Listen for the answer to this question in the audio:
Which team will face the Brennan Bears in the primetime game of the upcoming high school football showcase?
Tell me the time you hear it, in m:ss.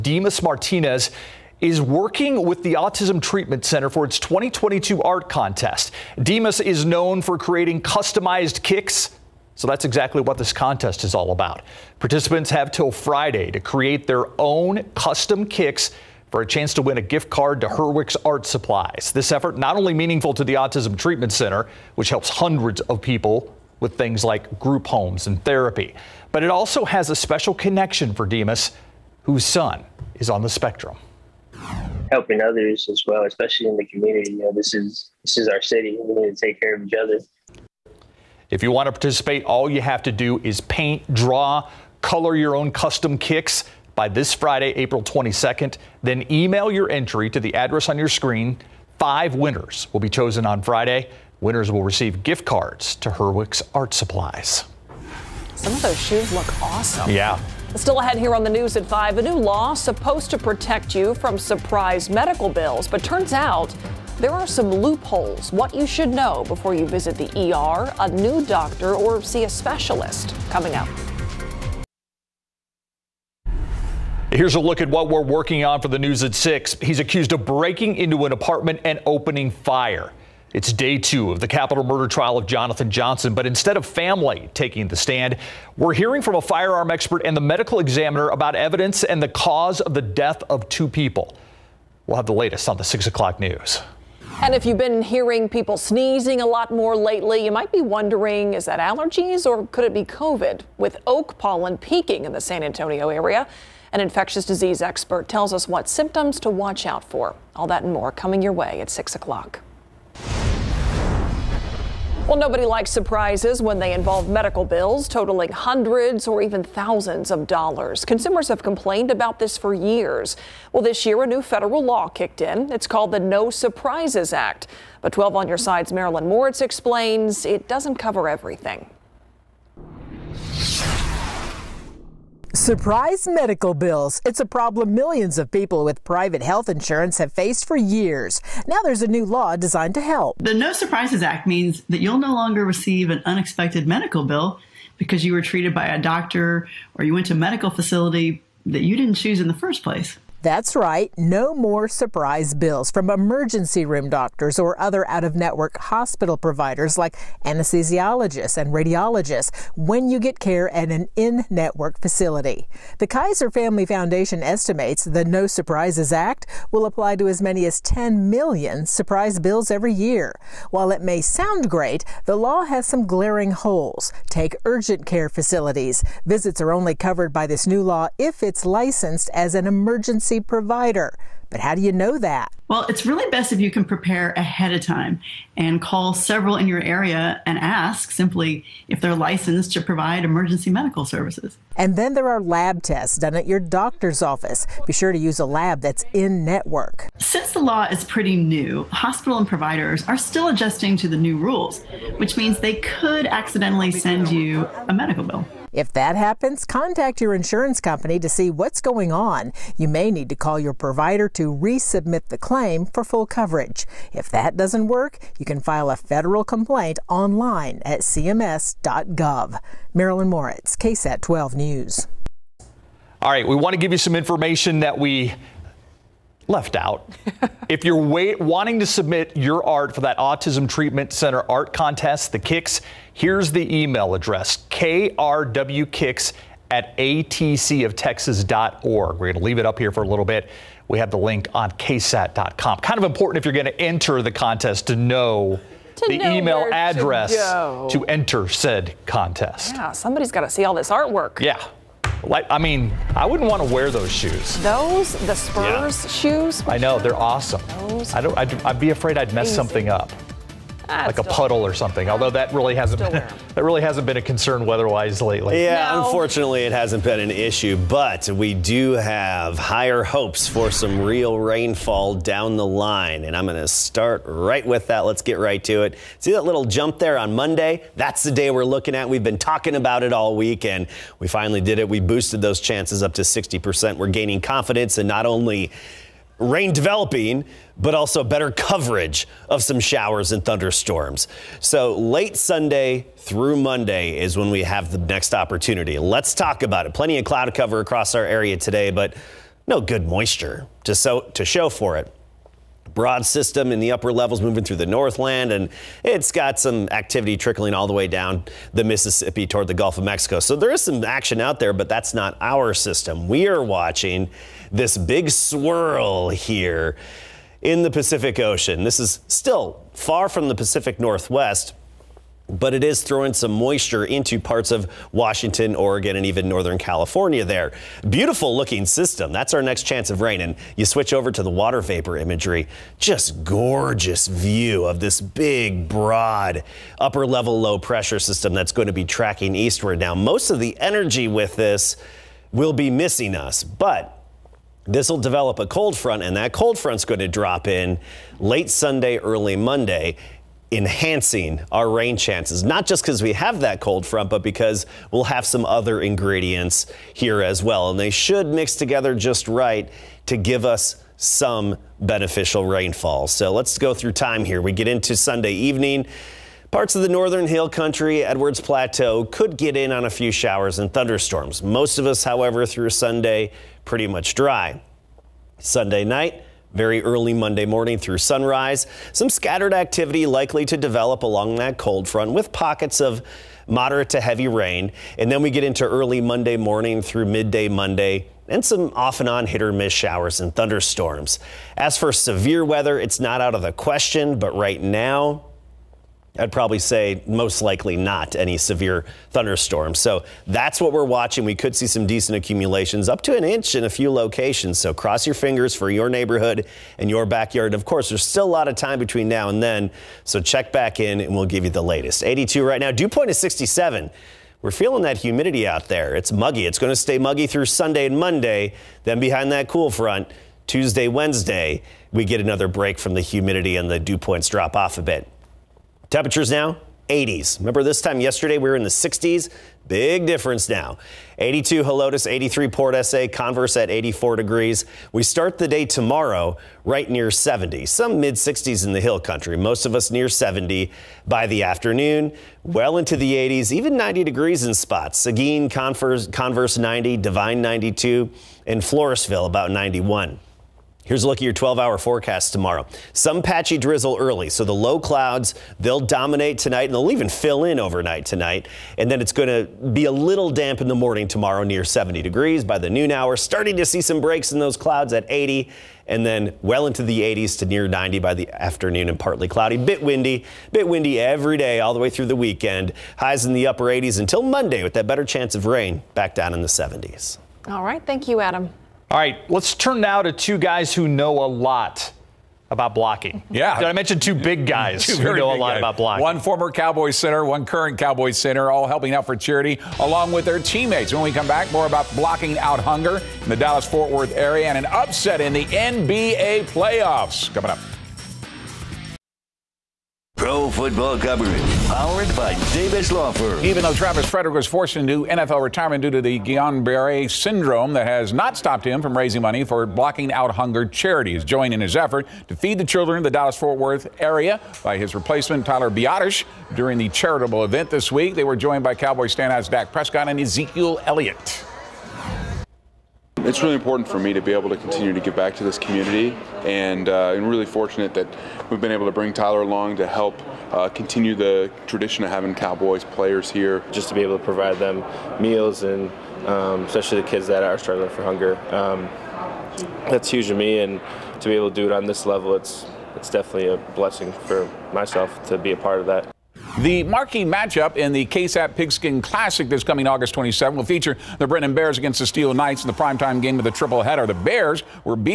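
9:12.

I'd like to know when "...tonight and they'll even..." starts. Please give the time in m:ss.
7:36.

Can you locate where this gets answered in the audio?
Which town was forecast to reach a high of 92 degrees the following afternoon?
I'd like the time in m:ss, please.
7:27.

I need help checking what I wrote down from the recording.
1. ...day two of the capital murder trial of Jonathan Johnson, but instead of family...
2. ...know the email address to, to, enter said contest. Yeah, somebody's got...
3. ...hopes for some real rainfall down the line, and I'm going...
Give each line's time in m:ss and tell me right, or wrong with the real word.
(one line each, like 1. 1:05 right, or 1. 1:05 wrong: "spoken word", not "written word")
1. 1:20 right
2. 4:04 right
3. 4:30 right.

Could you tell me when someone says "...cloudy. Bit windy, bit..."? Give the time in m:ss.
7:49.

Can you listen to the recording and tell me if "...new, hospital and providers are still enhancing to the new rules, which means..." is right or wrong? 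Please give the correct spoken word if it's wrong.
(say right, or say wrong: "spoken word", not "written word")
wrong: "adjusting", not "enhancing".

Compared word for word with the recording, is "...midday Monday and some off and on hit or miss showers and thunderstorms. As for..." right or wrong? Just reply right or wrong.
right.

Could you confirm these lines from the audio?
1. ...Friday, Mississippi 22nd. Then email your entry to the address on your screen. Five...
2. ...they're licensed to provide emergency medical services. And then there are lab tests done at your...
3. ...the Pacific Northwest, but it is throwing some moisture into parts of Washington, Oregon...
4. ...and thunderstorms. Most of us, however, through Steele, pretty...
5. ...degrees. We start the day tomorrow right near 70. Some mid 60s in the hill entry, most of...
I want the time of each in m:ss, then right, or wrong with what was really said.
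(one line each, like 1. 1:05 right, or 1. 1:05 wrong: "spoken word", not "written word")
1. 0:44 wrong: "April", not "Mississippi"
2. 3:09 right
3. 5:20 right
4. 6:10 wrong: "Sunday", not "Steele"
5. 7:14 wrong: "country", not "entry".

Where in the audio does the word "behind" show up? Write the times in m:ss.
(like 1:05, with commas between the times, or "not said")
6:59.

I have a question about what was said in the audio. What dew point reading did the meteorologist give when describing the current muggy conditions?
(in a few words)
67.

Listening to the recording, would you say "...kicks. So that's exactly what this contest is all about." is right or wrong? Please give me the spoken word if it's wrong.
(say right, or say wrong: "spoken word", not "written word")
right.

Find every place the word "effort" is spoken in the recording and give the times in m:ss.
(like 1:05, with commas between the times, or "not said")
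0:19, 8:31.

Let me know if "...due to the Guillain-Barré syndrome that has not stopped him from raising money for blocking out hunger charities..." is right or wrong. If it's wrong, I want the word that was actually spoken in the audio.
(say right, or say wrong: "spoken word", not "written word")
right.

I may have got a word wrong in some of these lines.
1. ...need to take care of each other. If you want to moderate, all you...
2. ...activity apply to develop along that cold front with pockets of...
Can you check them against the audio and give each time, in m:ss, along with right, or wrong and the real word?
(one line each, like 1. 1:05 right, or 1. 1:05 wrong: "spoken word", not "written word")
1. 0:36 wrong: "participate", not "moderate"
2. 6:19 wrong: "likely", not "apply".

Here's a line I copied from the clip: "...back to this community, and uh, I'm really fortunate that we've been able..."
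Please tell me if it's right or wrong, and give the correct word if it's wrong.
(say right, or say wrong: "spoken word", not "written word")
right.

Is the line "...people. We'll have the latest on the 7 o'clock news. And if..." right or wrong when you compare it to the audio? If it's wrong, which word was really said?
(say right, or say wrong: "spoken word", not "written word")
wrong: "6", not "7".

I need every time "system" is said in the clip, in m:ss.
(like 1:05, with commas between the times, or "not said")
5:03, 5:12, 5:28, 5:38.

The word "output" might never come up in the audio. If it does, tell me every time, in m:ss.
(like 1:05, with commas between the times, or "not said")
not said.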